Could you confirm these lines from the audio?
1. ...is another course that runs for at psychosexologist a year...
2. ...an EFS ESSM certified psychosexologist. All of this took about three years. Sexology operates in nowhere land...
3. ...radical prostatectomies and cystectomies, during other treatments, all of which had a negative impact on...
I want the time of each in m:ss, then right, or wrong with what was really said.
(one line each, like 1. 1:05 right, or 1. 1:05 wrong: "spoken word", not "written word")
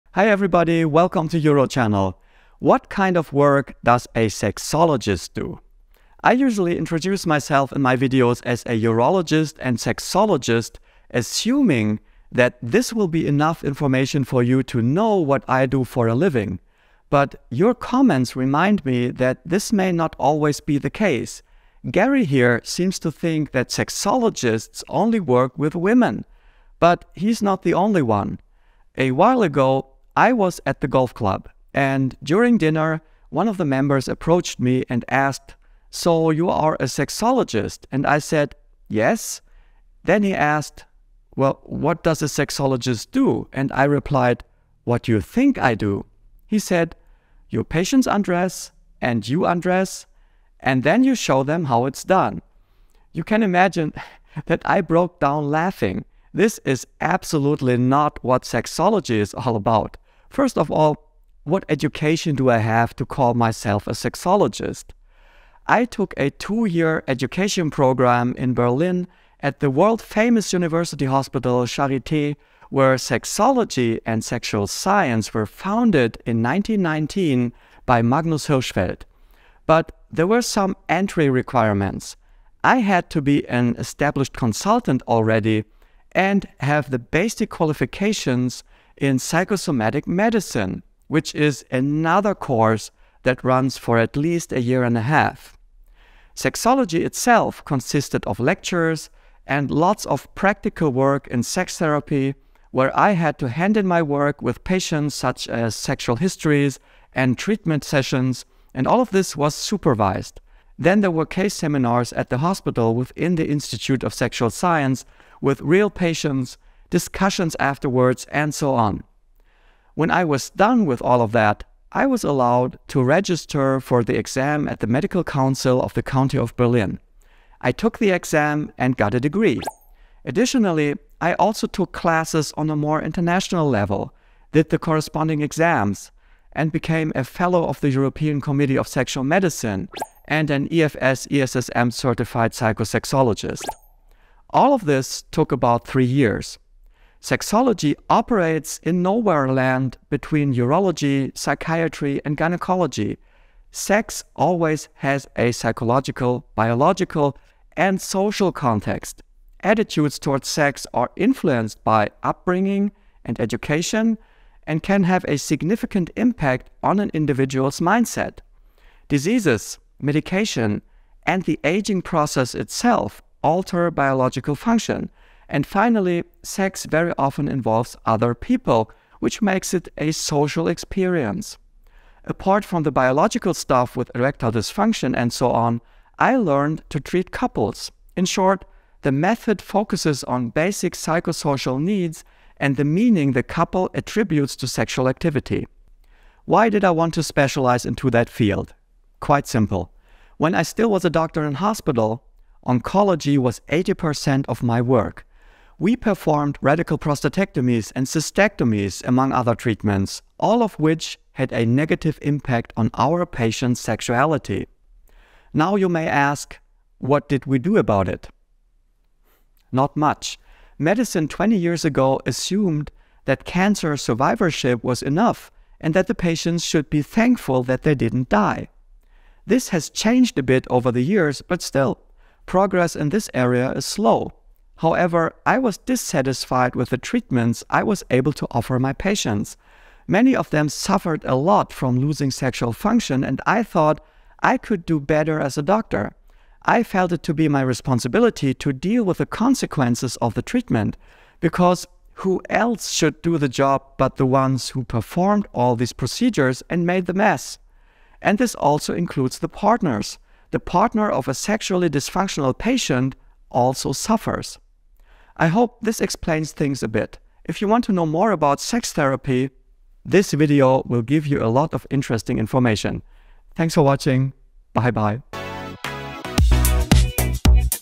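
1. 1:31 wrong: "least", not "psychosexologist"
2. 2:20 right
3. 3:26 wrong: "among", not "during".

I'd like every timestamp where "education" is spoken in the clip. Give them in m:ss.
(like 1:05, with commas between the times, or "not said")
1:01, 1:07, 2:43.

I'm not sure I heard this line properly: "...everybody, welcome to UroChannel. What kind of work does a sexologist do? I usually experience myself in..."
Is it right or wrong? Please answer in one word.
wrong.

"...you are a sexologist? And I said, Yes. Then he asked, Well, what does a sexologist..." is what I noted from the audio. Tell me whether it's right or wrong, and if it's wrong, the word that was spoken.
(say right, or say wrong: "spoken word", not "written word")
right.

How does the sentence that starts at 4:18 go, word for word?
And this also includes the partners the partner of a sexually dysfunctional patient also suffers.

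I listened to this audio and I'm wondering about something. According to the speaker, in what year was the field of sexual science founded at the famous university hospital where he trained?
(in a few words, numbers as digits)
1919.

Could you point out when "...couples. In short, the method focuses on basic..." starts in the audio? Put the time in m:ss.
3:07.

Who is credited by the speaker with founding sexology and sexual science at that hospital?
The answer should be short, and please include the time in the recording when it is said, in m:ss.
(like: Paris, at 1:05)
Magnus Hirschfeld, at 1:18.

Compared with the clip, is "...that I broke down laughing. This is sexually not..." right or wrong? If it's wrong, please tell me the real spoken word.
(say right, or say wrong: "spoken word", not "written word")
wrong: "absolutely", not "sexually".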